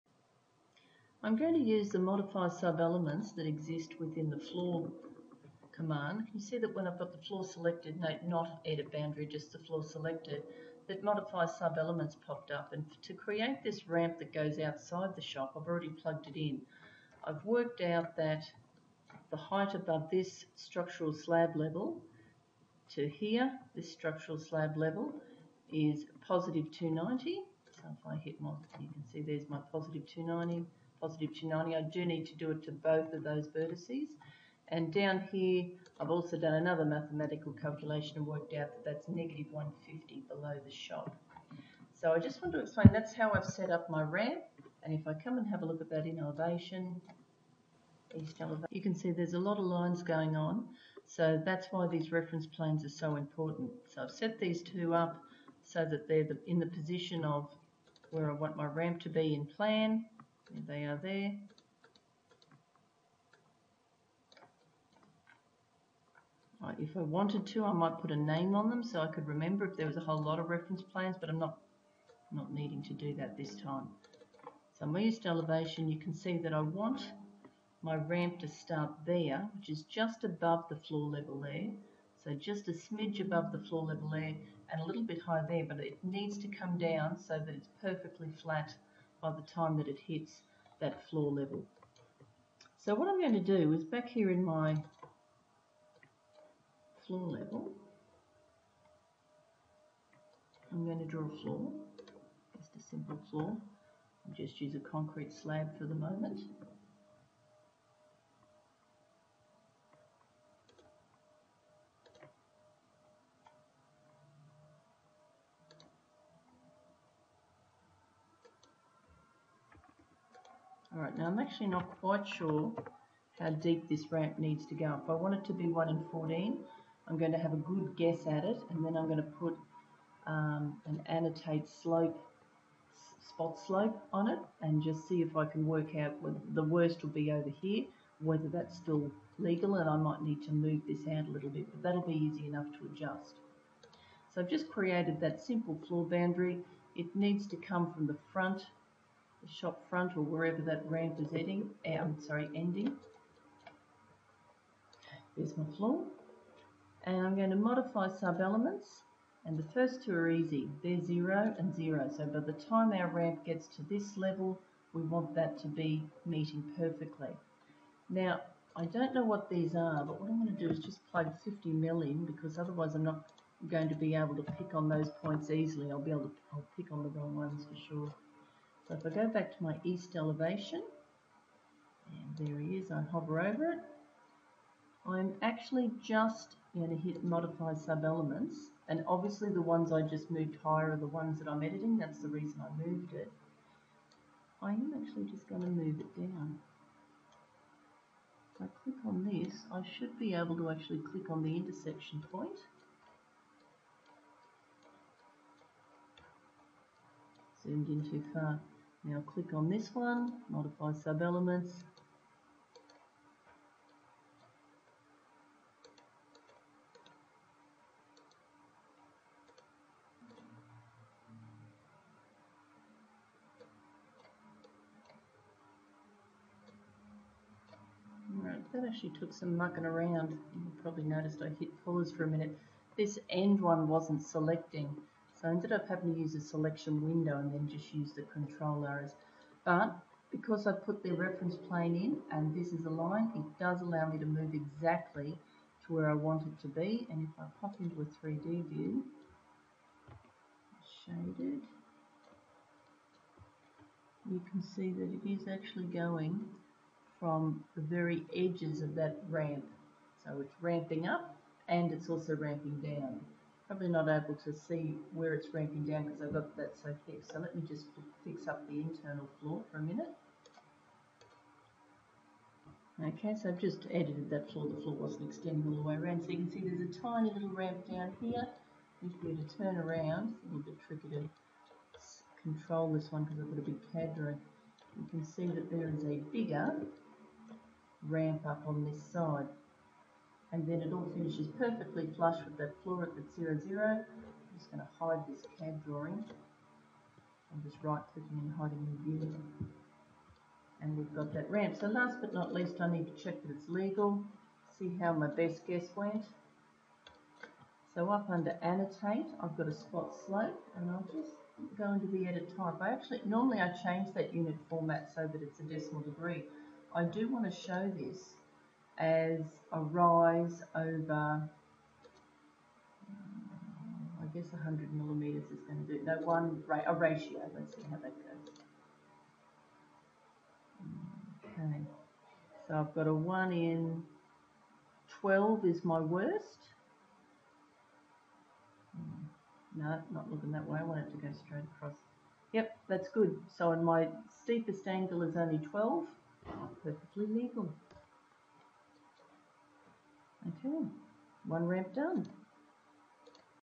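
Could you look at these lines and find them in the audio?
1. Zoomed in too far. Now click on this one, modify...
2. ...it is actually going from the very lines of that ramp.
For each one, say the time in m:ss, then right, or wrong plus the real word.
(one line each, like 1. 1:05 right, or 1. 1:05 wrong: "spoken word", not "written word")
1. 3:27 right
2. 4:15 wrong: "edges", not "lines".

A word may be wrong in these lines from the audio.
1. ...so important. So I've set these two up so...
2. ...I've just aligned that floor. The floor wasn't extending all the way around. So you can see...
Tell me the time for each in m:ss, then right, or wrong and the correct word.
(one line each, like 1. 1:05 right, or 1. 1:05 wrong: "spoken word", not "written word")
1. 0:52 right
2. 4:33 wrong: "edited", not "aligned".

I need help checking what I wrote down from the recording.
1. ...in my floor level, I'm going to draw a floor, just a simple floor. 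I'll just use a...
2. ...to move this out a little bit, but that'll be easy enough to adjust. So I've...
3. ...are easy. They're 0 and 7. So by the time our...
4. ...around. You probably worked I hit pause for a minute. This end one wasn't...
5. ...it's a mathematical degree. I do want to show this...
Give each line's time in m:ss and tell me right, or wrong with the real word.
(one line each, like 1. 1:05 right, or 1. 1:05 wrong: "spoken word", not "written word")
1. 1:34 right
2. 2:20 right
3. 2:40 wrong: "0", not "7"
4. 3:49 wrong: "noticed", not "worked"
5. 5:15 wrong: "decimal", not "mathematical".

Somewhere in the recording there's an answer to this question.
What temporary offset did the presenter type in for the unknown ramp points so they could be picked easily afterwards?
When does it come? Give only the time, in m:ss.
2:51.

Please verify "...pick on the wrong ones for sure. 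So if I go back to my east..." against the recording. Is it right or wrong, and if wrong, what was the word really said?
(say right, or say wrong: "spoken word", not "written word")
right.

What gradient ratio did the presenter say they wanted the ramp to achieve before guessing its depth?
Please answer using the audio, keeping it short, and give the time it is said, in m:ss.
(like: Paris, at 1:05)
1 in 14, at 2:05.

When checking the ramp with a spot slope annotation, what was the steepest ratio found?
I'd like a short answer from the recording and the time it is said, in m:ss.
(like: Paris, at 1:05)
1 in 12, at 5:33.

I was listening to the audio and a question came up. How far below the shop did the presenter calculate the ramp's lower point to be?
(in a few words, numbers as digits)
150.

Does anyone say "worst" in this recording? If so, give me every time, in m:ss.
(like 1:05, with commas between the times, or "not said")
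2:16, 5:35.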